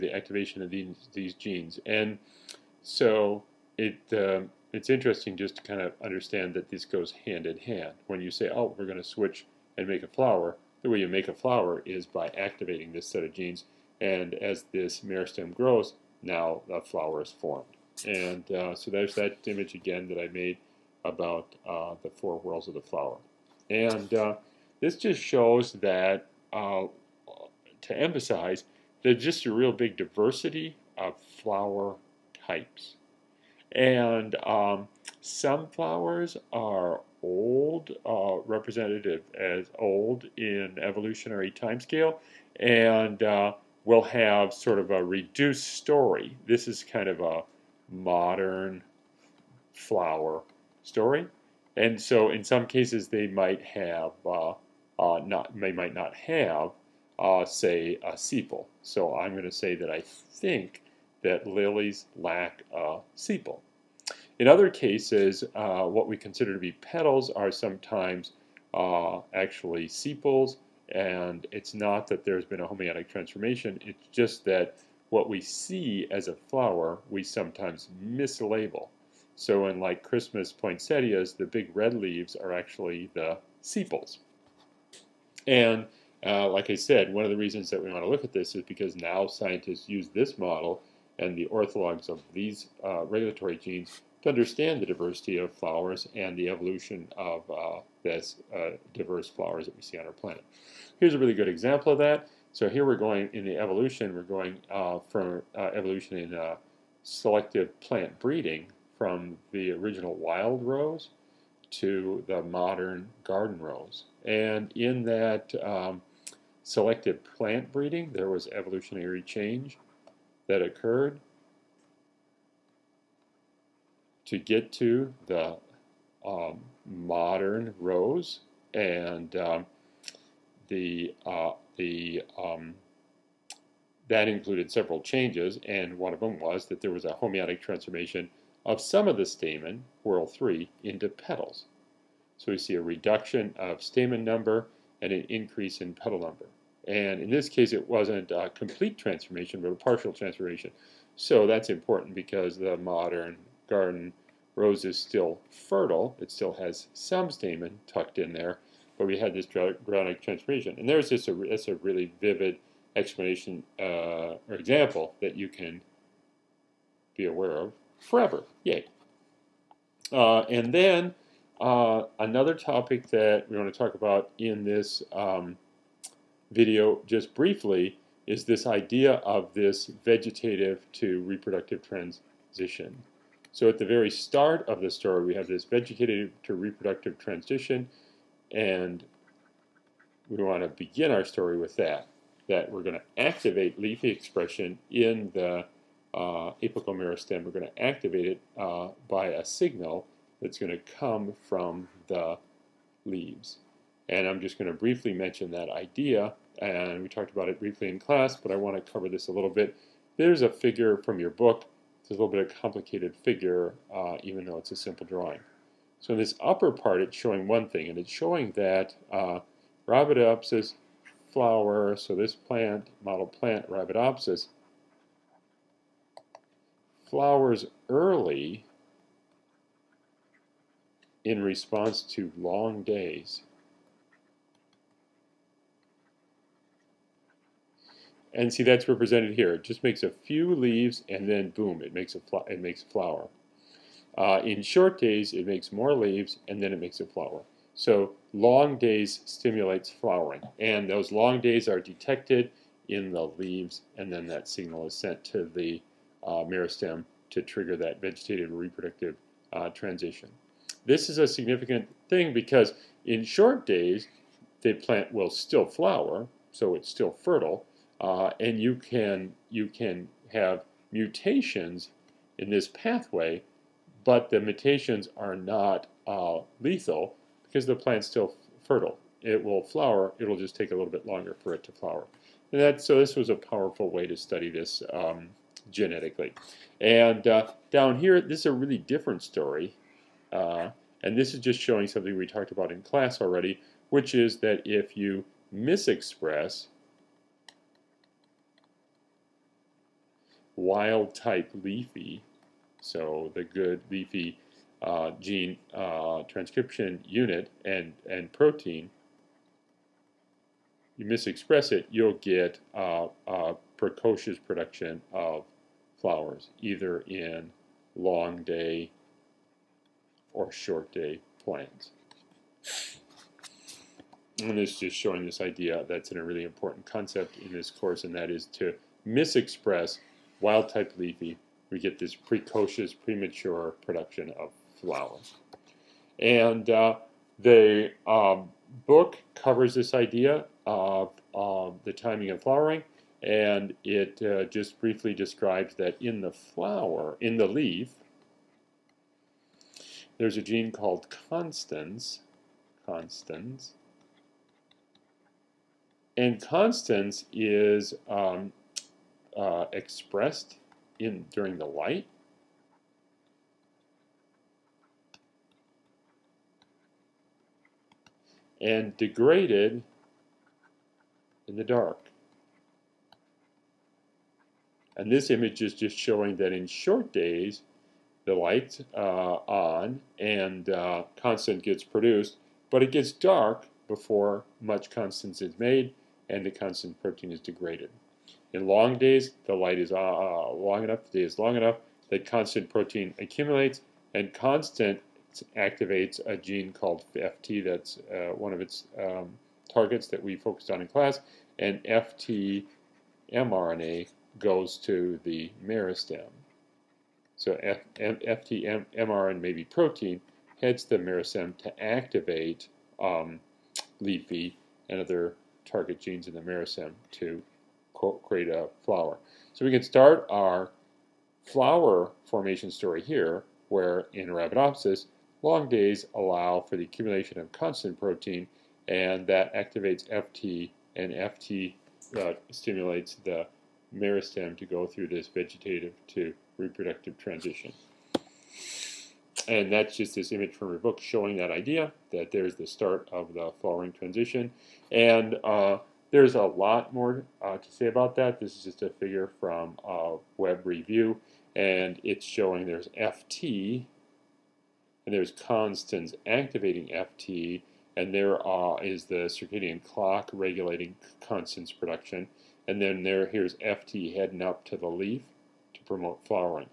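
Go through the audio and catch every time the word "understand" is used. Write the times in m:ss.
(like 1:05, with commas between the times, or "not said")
0:06, 1:34.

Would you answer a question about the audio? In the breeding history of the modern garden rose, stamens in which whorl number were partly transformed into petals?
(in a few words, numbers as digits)
3.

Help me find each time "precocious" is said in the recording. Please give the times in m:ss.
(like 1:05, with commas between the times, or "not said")
5:13, 5:32.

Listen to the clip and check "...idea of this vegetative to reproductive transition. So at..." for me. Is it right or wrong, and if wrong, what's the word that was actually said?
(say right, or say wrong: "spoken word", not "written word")
right.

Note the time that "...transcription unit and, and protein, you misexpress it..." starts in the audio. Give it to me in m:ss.
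5:06.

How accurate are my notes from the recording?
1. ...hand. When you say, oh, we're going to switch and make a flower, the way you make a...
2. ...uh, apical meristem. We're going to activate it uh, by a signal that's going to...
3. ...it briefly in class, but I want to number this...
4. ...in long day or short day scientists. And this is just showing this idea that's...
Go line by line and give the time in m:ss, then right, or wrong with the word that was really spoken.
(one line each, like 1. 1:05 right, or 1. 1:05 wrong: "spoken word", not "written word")
1. 0:07 right
2. 3:16 right
3. 3:27 wrong: "cover", not "number"
4. 5:17 wrong: "plants", not "scientists".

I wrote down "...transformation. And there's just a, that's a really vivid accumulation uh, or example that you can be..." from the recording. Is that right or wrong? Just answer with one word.
wrong.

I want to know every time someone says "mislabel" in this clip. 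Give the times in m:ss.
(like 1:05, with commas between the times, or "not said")
1:18.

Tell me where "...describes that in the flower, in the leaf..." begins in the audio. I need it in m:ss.
5:45.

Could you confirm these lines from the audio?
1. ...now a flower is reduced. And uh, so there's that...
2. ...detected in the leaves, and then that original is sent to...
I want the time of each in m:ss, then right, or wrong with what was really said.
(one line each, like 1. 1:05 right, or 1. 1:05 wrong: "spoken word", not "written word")
1. 0:16 wrong: "formed", not "reduced"
2. 4:11 wrong: "signal", not "original".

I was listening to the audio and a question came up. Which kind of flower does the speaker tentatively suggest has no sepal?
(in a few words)
Lilies.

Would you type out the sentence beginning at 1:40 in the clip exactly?
Here's a really good example of that.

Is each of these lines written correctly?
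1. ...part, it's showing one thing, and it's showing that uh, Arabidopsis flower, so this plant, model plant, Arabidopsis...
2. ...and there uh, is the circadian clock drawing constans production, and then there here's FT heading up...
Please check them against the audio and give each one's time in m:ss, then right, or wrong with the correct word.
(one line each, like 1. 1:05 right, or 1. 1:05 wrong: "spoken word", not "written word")
1. 3:36 right
2. 7:37 wrong: "regulating", not "drawing".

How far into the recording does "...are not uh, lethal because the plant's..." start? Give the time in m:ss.
4:35.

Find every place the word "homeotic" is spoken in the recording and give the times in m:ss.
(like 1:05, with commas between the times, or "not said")
1:12, 2:17.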